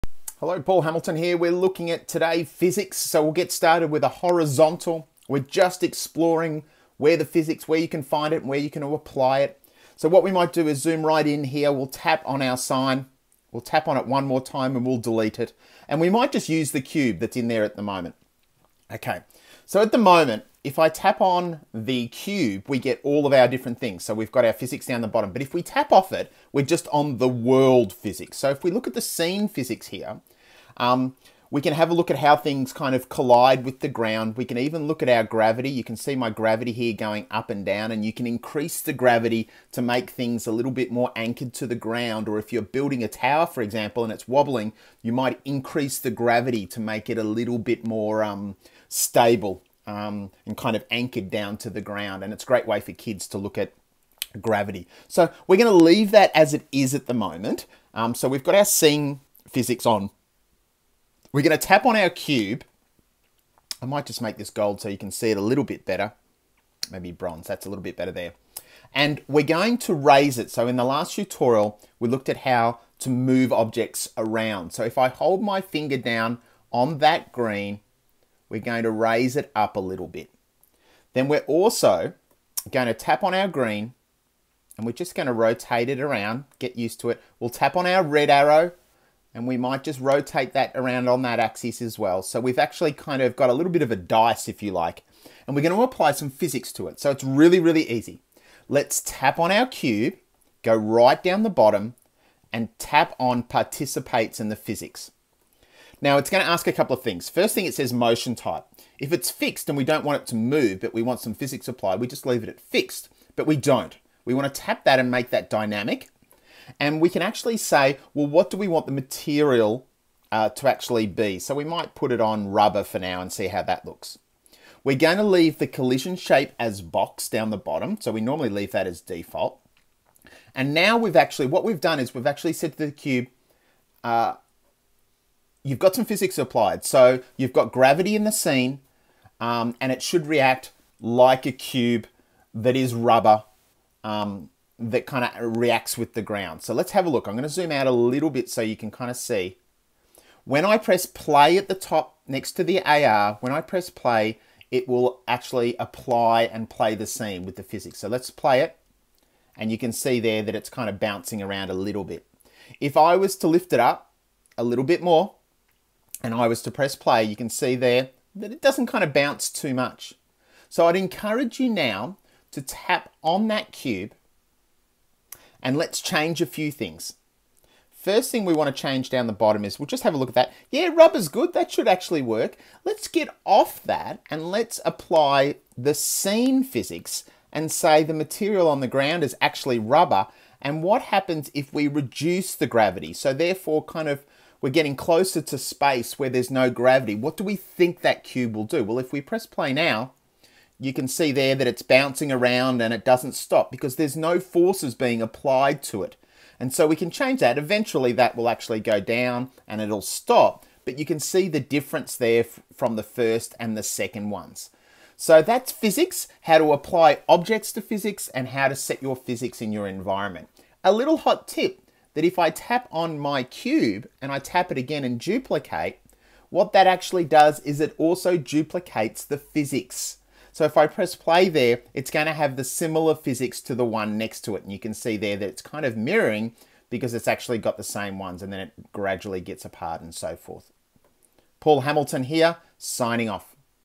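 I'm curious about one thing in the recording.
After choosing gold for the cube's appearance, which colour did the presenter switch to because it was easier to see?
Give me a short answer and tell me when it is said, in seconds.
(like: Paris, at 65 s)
Bronze, at 66 s.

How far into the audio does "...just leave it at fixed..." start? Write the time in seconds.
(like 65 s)
112 s.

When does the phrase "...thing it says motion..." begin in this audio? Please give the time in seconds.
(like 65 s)
107 s.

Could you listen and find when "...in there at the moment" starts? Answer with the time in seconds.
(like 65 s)
17 s.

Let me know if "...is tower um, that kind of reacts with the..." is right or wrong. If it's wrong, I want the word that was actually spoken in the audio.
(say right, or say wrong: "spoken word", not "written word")
wrong: "rubber", not "tower".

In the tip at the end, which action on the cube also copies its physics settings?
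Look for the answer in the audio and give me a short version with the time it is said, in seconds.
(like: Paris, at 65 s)
Duplicate, at 225 s.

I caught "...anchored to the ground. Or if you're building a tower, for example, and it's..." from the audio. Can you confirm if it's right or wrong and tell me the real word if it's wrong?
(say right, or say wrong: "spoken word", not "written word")
right.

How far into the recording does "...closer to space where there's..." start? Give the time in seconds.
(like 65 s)
194 s.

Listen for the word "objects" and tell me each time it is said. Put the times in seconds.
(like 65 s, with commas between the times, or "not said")
73 s, 217 s.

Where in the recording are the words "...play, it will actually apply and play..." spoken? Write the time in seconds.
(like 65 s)
153 s.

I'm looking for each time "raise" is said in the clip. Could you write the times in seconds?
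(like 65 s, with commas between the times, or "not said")
69 s, 78 s.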